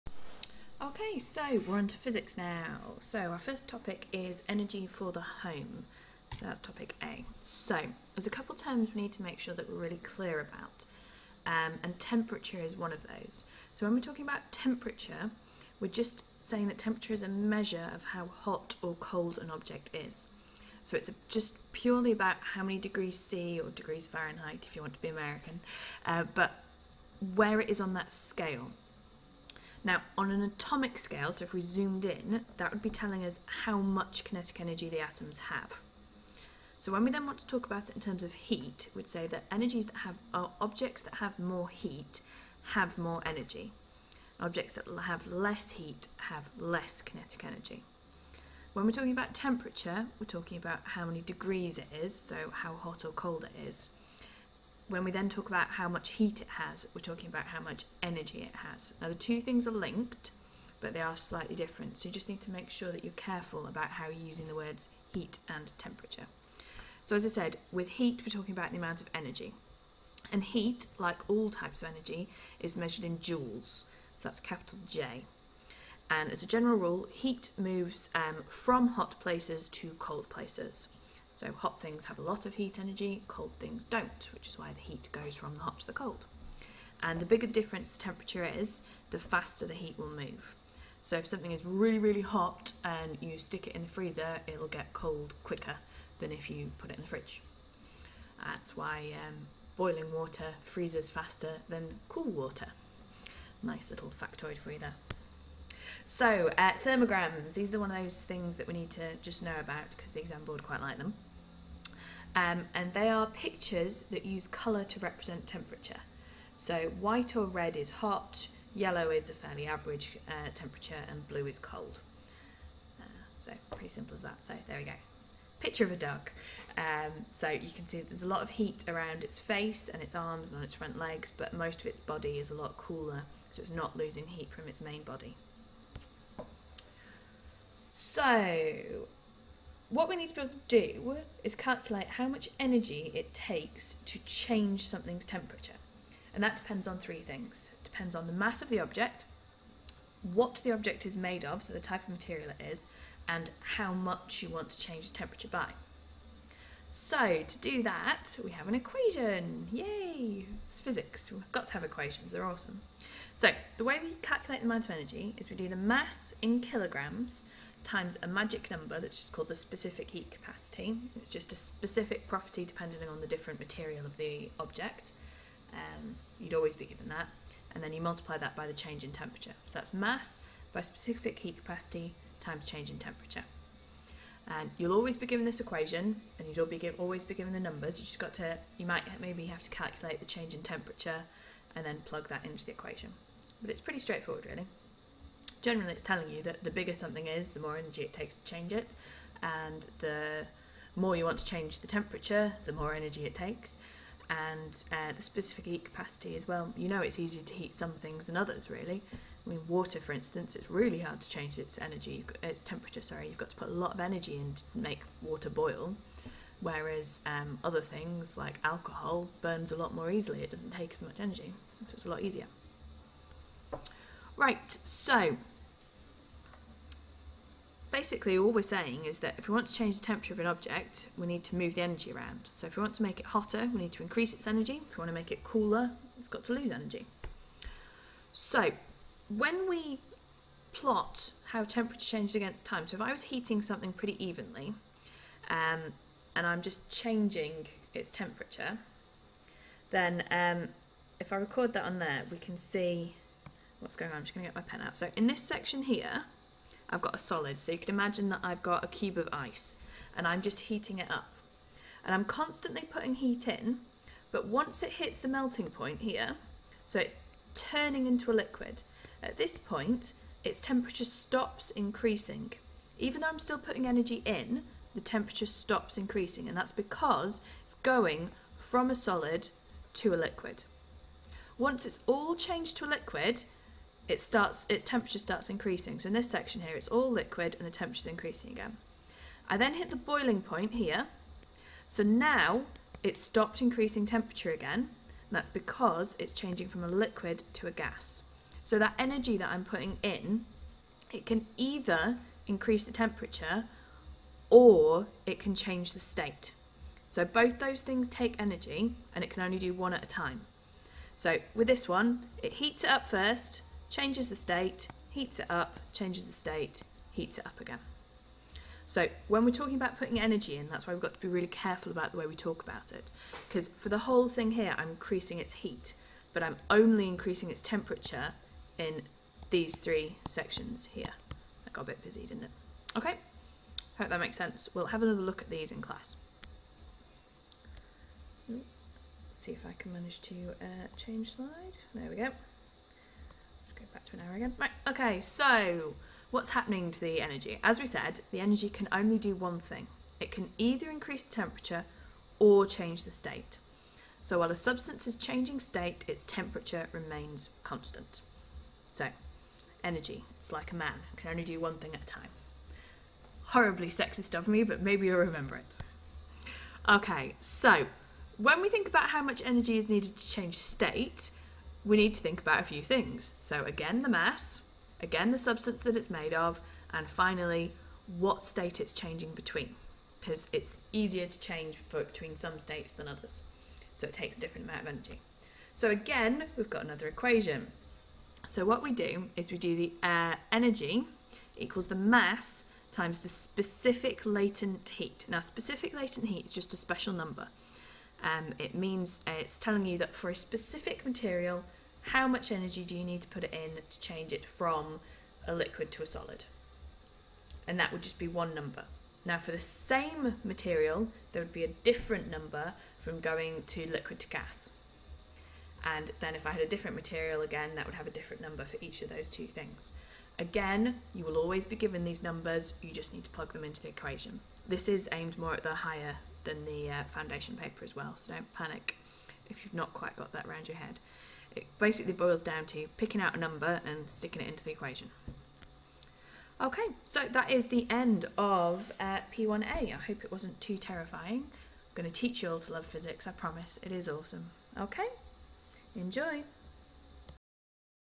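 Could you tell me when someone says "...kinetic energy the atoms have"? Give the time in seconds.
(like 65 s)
34 s.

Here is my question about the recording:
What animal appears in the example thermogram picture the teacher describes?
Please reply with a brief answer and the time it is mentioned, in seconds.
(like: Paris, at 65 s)
A dog, at 125 s.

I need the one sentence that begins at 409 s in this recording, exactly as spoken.
Now for the same material, there would be a different number from going to liquid to gas.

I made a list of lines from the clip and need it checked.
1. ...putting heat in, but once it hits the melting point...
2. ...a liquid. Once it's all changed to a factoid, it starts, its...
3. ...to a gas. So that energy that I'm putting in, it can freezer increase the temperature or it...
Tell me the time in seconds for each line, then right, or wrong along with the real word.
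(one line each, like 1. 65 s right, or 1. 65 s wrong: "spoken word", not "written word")
1. 262 s right
2. 280 s wrong: "liquid", not "factoid"
3. 297 s wrong: "either", not "freezer".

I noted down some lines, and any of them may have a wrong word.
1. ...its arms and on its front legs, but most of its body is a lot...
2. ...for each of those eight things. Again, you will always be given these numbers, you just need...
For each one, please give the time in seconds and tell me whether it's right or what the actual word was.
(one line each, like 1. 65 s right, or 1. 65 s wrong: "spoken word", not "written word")
1. 130 s right
2. 418 s wrong: "two", not "eight".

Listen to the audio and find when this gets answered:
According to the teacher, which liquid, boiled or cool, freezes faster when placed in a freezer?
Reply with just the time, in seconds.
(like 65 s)
99 s.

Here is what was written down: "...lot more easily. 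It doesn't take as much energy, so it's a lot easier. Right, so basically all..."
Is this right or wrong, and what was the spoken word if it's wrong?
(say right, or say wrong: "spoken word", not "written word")
right.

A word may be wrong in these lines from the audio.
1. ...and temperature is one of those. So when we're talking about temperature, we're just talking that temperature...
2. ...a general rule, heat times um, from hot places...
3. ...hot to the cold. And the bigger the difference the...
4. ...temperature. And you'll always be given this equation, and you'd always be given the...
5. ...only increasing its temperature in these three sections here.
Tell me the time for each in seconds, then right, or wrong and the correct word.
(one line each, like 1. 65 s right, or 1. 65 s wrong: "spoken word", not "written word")
1. 11 s wrong: "saying", not "talking"
2. 76 s wrong: "moves", not "times"
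3. 85 s right
4. 182 s right
5. 326 s right.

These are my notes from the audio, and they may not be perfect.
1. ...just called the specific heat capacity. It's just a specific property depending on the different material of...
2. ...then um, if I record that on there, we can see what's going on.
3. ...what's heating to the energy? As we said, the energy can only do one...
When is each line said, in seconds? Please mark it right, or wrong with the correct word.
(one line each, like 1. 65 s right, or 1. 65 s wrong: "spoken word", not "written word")
1. 169 s right
2. 249 s right
3. 346 s wrong: "happening", not "heating".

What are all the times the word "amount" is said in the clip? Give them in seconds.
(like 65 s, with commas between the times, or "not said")
68 s, 164 s, 384 s.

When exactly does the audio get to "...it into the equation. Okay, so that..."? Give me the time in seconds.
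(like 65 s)
434 s.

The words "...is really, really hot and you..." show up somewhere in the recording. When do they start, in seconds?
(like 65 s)
91 s.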